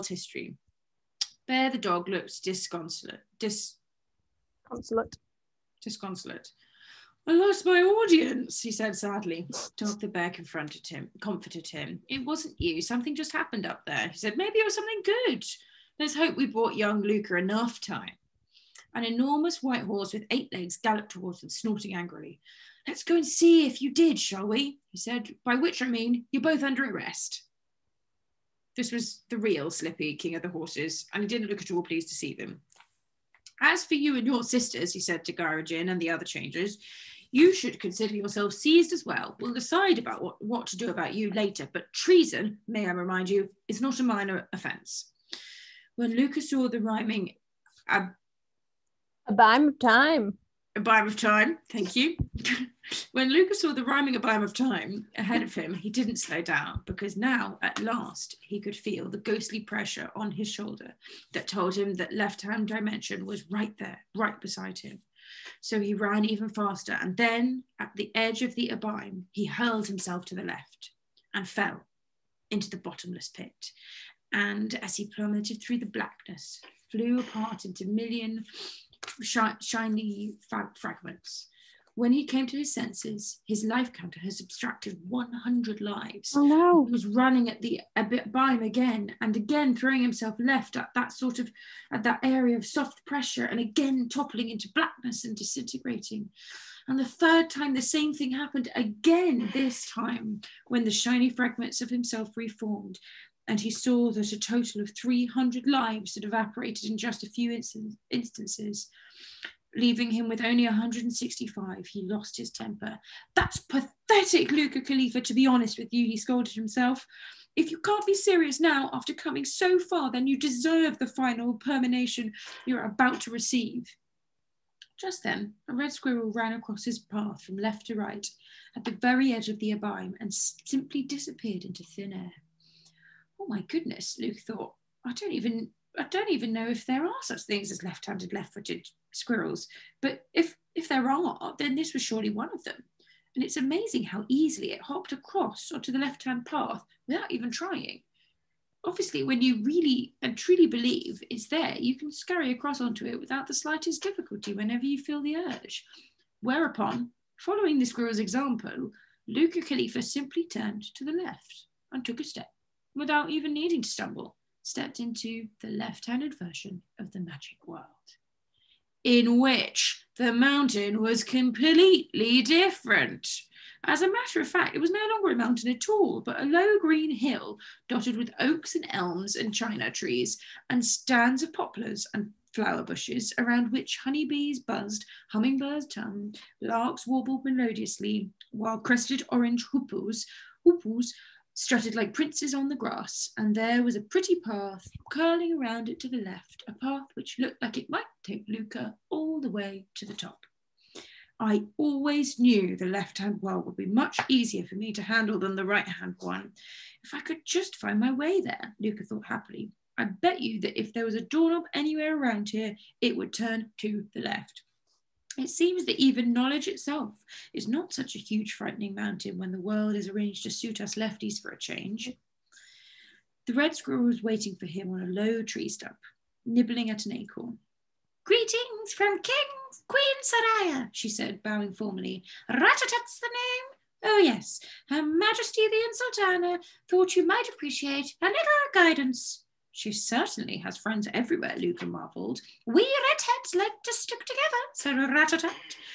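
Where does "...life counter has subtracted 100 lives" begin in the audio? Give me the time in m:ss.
1:23.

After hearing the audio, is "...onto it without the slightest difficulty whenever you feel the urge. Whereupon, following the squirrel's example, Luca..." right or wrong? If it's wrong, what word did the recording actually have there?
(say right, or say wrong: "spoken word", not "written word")
right.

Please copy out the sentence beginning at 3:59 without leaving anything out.
She certainly has friends everywhere, Luca marvelled.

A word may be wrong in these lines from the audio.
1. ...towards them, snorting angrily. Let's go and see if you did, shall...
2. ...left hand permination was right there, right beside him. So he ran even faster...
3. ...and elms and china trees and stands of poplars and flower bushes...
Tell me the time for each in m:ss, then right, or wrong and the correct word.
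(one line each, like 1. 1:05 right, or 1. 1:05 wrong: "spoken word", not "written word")
1. 0:21 right
2. 1:02 wrong: "dimension", not "permination"
3. 2:58 right.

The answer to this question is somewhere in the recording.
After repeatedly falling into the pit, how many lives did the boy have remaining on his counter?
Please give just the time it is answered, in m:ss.
1:50.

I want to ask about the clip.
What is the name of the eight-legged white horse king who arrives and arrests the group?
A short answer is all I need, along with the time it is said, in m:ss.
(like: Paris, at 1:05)
Slippy, at 0:29.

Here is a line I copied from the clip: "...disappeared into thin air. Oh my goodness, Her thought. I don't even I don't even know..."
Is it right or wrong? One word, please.
wrong.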